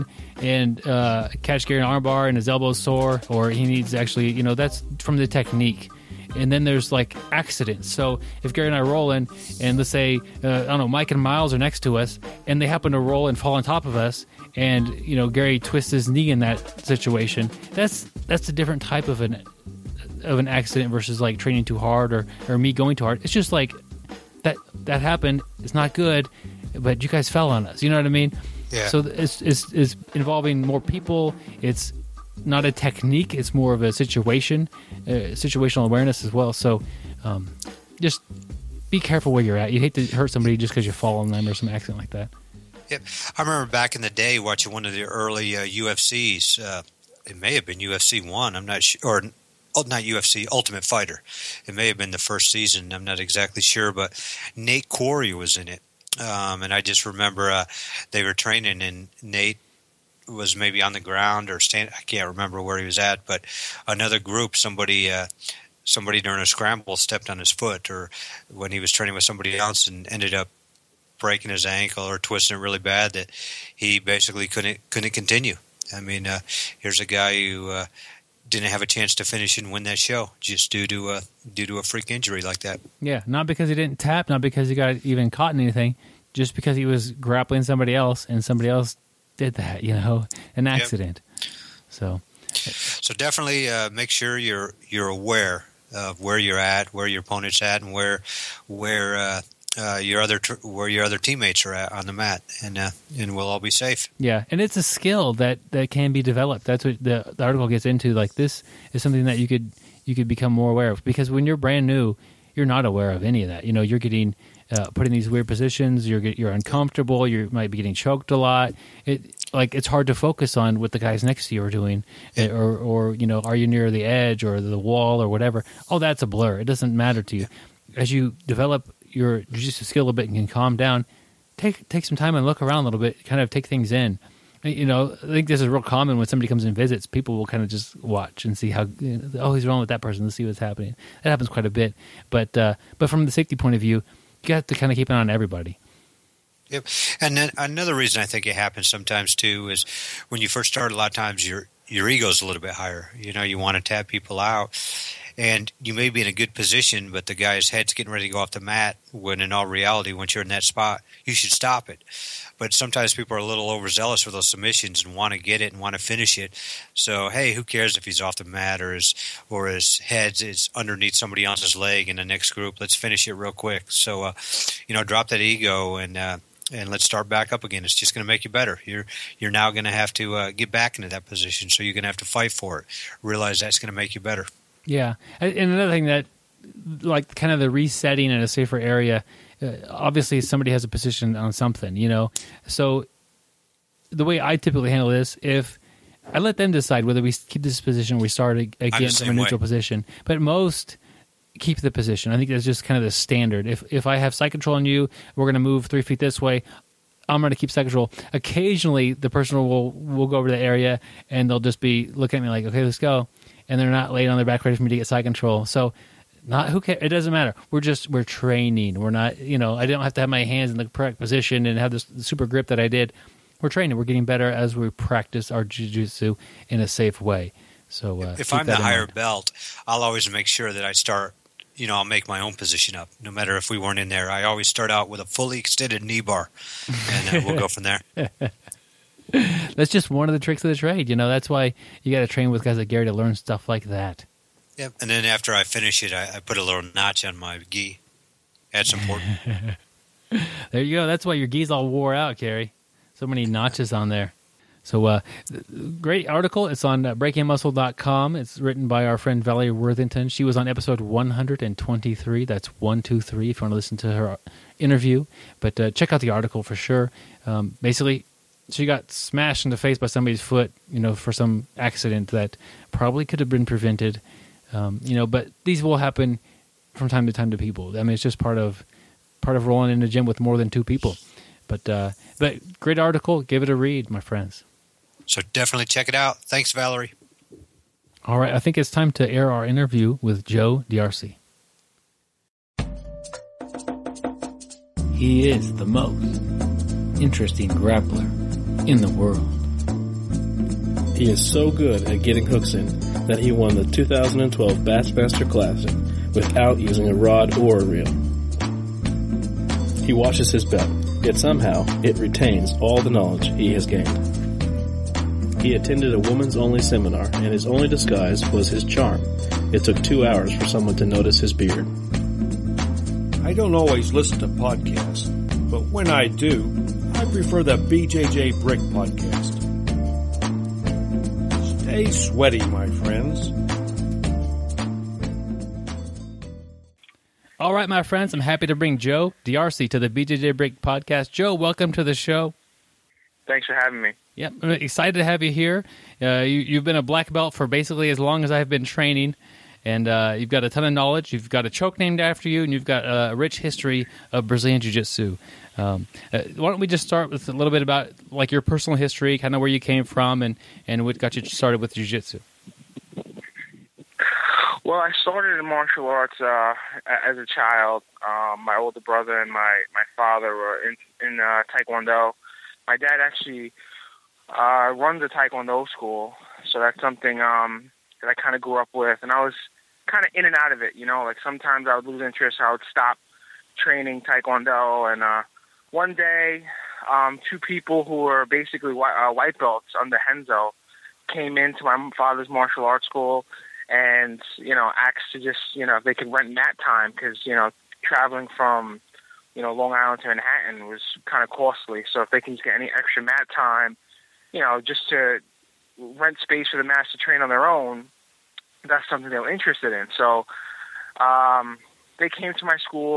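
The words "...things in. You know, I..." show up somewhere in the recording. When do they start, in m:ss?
2:13.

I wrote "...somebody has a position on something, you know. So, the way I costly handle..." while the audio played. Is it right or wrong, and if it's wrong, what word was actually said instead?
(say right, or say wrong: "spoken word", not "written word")
wrong: "typically", not "costly".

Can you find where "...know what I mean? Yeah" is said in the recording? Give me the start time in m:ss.
0:27.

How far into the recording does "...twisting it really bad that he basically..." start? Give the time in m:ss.
1:12.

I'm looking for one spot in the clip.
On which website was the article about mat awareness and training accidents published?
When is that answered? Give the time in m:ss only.
4:17.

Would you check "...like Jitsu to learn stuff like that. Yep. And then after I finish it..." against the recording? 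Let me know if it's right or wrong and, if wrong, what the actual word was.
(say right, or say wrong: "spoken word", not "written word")
wrong: "Gary", not "Jitsu".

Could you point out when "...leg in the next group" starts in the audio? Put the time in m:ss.
2:51.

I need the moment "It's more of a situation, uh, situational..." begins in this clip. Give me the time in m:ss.
0:33.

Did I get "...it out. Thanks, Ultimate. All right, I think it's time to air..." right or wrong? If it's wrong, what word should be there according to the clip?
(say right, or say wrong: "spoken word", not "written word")
wrong: "Valerie", not "Ultimate".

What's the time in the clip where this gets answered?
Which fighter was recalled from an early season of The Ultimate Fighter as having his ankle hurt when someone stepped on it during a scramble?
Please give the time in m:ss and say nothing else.
0:54.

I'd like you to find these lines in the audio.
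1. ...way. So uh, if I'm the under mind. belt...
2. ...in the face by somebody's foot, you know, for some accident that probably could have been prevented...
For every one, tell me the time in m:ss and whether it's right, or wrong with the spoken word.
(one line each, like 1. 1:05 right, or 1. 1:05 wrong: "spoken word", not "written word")
1. 3:47 wrong: "higher", not "under"
2. 4:29 right.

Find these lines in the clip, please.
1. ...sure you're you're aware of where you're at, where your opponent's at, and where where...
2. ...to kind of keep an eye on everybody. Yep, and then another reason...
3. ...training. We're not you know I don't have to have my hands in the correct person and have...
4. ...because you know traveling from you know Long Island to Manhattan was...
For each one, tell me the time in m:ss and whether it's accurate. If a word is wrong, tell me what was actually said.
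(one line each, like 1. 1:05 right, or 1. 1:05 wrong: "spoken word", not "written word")
1. 1:34 right
2. 2:24 right
3. 3:38 wrong: "position", not "person"
4. 6:37 right.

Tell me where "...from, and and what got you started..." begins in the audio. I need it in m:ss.
6:00.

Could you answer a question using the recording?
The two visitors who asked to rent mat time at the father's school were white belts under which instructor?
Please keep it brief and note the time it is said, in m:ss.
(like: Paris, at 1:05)
Renzo, at 6:30.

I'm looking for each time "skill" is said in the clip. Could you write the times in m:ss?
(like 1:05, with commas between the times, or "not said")
1:44, 2:09.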